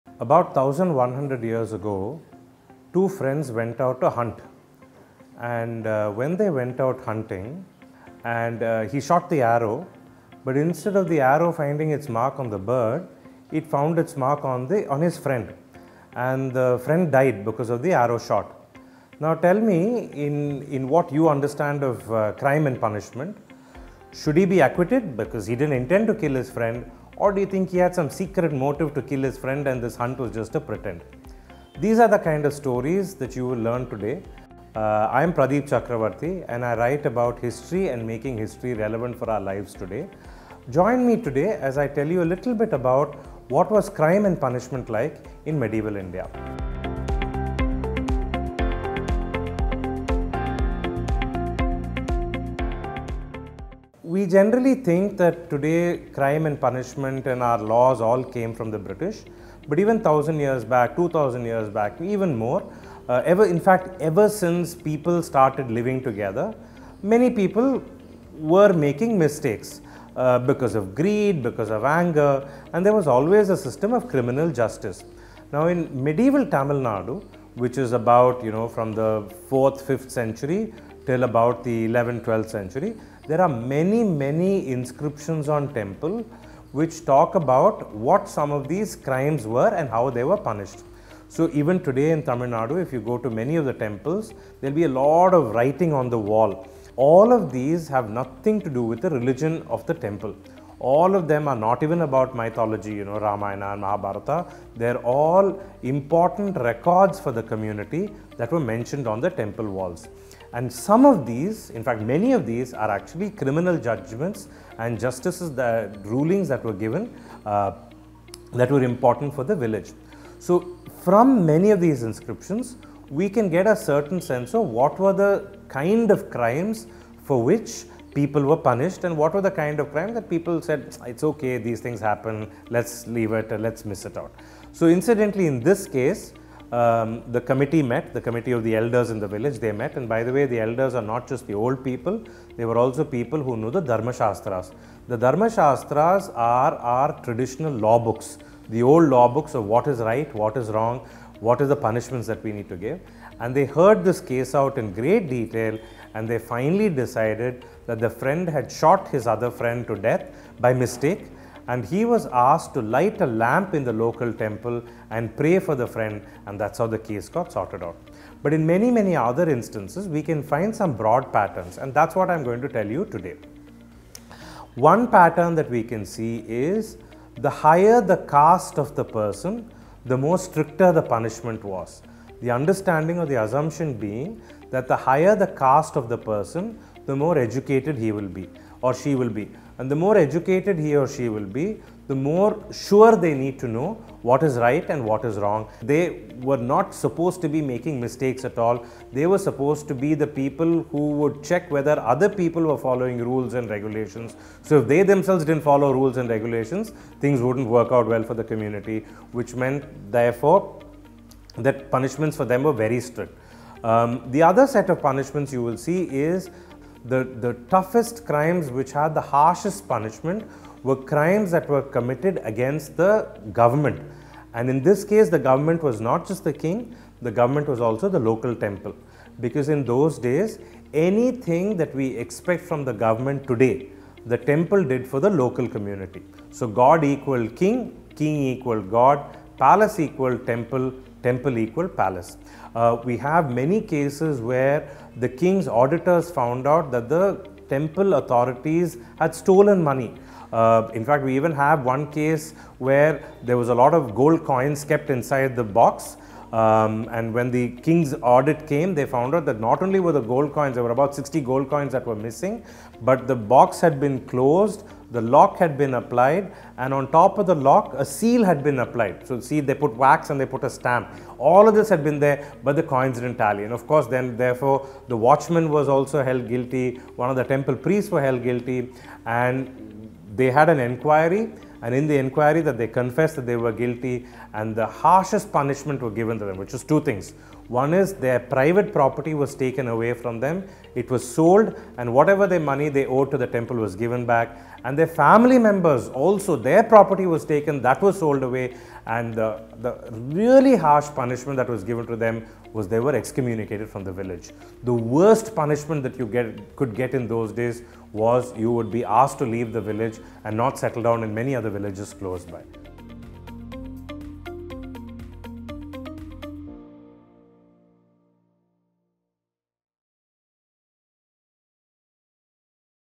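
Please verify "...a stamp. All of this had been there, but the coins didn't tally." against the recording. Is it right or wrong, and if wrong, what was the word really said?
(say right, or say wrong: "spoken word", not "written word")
right.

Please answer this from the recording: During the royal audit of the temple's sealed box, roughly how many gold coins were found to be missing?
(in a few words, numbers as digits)
60.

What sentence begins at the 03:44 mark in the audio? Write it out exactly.
And in this case, the government was not just the king, the government was also the local temple.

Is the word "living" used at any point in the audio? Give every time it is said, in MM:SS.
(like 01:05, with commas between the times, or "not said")
01:05.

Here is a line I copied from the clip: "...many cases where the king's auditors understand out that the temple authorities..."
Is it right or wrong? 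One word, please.
wrong.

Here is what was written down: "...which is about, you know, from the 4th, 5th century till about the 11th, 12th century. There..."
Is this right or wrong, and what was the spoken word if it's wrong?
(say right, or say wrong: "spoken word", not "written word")
right.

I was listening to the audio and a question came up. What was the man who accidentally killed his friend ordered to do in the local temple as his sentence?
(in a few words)
light a lamp.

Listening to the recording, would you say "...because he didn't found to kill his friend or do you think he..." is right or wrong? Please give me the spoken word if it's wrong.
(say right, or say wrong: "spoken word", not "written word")
wrong: "intend", not "found".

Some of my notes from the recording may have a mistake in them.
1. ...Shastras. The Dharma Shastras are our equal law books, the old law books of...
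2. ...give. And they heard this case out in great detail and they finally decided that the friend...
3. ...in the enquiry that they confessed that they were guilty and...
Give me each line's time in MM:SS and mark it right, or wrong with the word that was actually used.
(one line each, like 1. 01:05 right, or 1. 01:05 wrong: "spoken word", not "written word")
1. 02:24 wrong: "traditional", not "equal"
2. 02:32 right
3. 04:41 wrong: "inquiry", not "enquiry".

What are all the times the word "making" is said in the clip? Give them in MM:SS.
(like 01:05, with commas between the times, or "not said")
00:38, 01:08, 03:17.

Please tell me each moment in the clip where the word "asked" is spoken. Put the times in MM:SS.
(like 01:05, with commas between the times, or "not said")
02:42, 05:09.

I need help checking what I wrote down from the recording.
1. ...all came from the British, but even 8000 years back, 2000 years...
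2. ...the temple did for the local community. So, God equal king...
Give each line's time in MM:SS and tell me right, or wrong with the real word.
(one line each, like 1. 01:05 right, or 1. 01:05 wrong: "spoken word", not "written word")
1. 00:58 wrong: "1000", not "8000"
2. 03:54 right.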